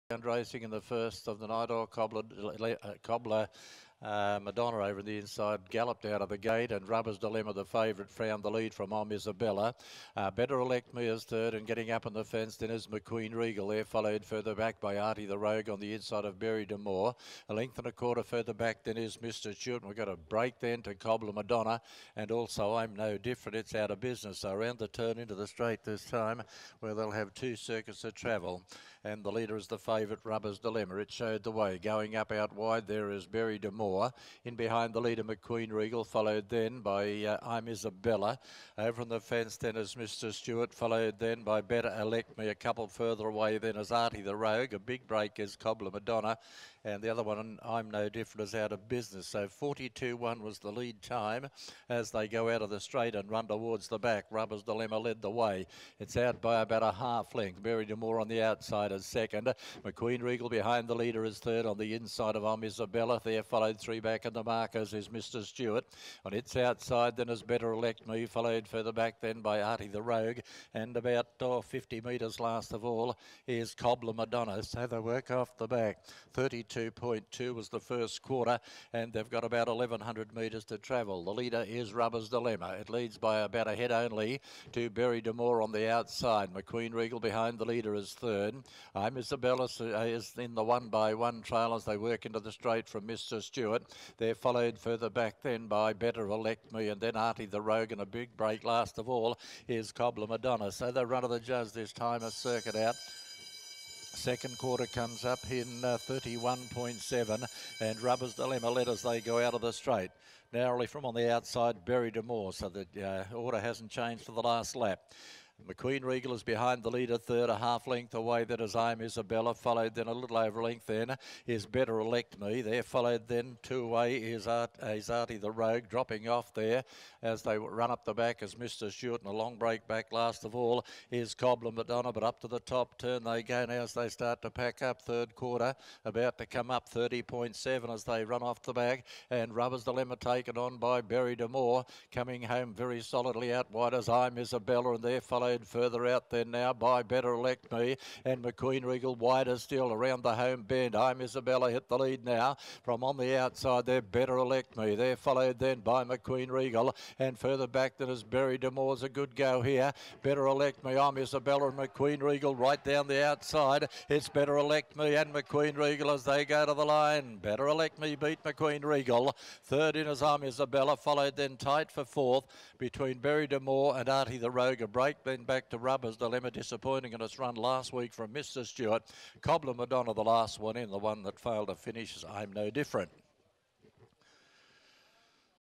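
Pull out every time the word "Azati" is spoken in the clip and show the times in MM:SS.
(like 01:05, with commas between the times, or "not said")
02:04.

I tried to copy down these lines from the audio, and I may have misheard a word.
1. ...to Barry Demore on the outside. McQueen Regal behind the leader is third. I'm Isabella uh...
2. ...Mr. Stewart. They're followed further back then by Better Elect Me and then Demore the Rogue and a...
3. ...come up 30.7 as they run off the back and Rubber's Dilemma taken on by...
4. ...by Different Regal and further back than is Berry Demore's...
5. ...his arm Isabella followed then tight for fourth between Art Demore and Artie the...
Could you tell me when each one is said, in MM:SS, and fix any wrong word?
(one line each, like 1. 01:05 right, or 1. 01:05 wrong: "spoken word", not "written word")
1. 01:24 right
2. 01:33 wrong: "Artie", not "Demore"
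3. 02:16 right
4. 02:35 wrong: "McQueen", not "Different"
5. 02:50 wrong: "Barry", not "Art".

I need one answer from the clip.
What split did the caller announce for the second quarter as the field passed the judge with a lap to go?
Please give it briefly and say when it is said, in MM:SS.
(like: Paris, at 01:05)
31.7, at 01:45.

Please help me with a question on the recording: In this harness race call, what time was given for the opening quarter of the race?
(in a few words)
32.2.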